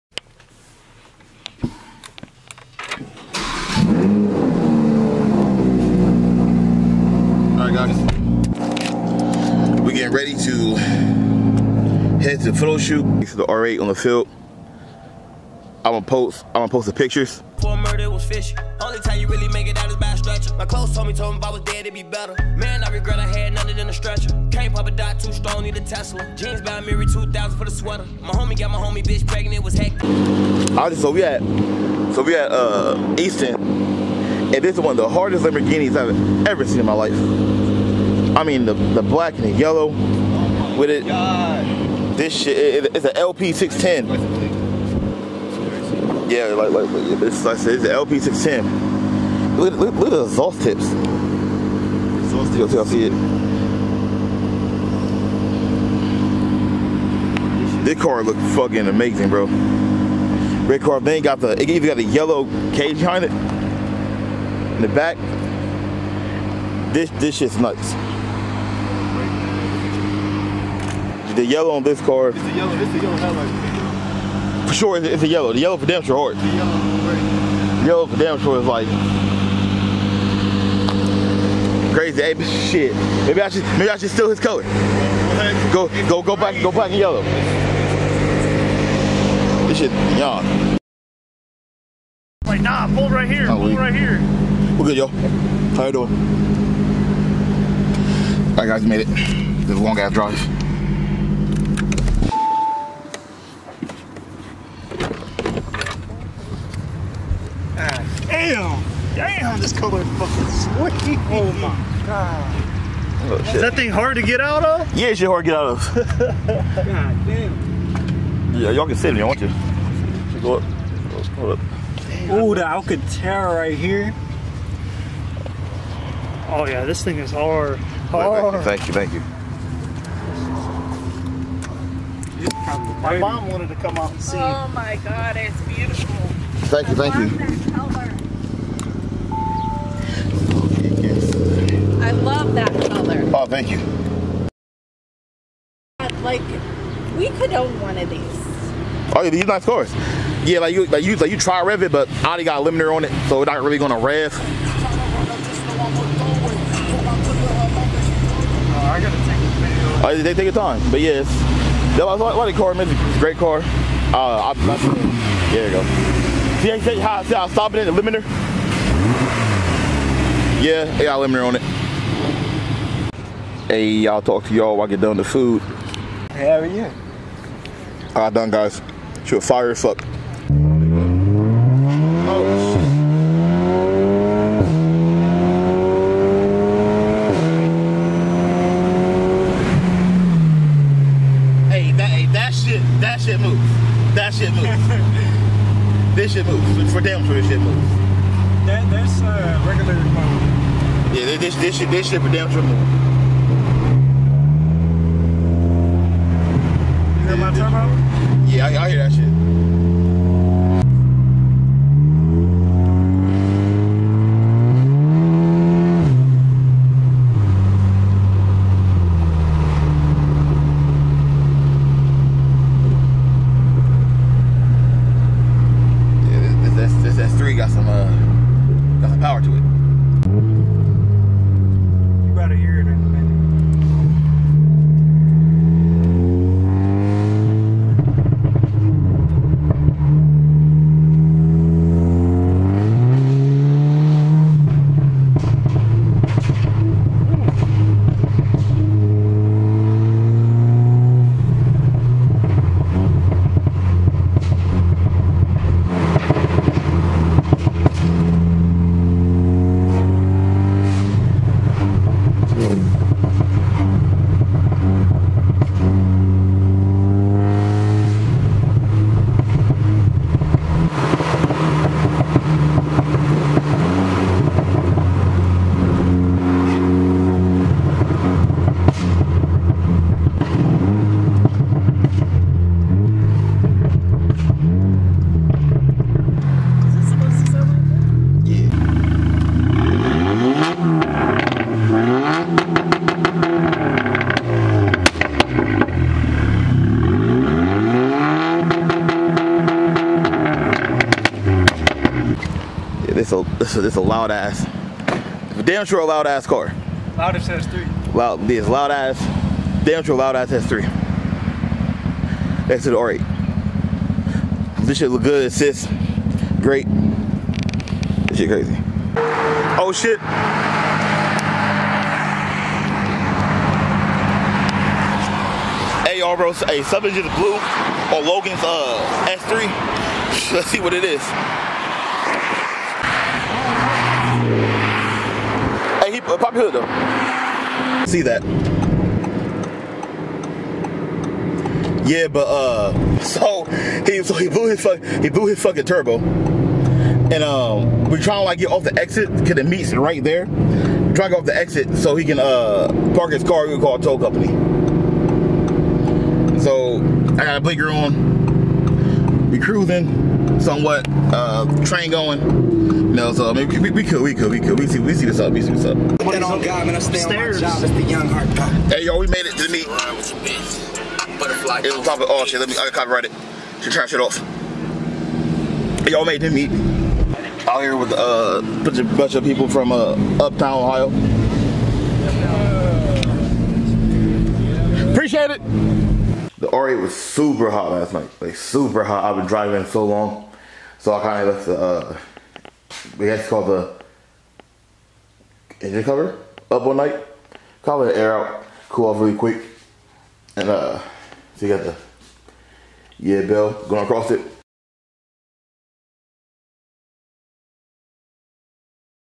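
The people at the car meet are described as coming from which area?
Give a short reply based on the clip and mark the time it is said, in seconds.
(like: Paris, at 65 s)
Uptown Ohio, at 380 s.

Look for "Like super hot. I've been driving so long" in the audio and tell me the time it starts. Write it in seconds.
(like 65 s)
388 s.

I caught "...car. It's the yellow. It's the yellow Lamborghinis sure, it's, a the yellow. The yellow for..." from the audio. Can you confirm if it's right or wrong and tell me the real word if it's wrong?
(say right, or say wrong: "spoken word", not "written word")
wrong: "For", not "Lamborghinis".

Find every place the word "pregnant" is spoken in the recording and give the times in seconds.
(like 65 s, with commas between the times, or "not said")
29 s.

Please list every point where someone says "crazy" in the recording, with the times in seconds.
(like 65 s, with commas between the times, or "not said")
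81 s, 318 s.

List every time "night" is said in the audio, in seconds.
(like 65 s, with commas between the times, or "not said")
388 s, 396 s.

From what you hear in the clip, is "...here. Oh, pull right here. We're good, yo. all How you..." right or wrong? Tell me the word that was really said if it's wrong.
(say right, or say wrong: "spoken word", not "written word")
right.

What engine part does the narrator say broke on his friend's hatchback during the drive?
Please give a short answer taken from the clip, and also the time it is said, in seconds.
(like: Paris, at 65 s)
Turbo, at 345 s.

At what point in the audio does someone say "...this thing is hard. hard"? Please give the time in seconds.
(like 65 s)
126 s.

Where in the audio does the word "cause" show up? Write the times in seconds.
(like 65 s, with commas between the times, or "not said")
349 s.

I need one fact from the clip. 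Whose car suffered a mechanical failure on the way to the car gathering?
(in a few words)
Logan's.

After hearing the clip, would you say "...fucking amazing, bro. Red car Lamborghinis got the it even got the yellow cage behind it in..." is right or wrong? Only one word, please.
wrong.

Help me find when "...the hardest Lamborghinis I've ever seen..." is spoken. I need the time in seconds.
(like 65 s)
34 s.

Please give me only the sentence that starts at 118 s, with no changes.
Yeah, y'all can sit if you want to.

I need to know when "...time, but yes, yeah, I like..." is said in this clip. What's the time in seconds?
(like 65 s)
160 s.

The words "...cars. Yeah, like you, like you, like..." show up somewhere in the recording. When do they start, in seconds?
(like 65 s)
149 s.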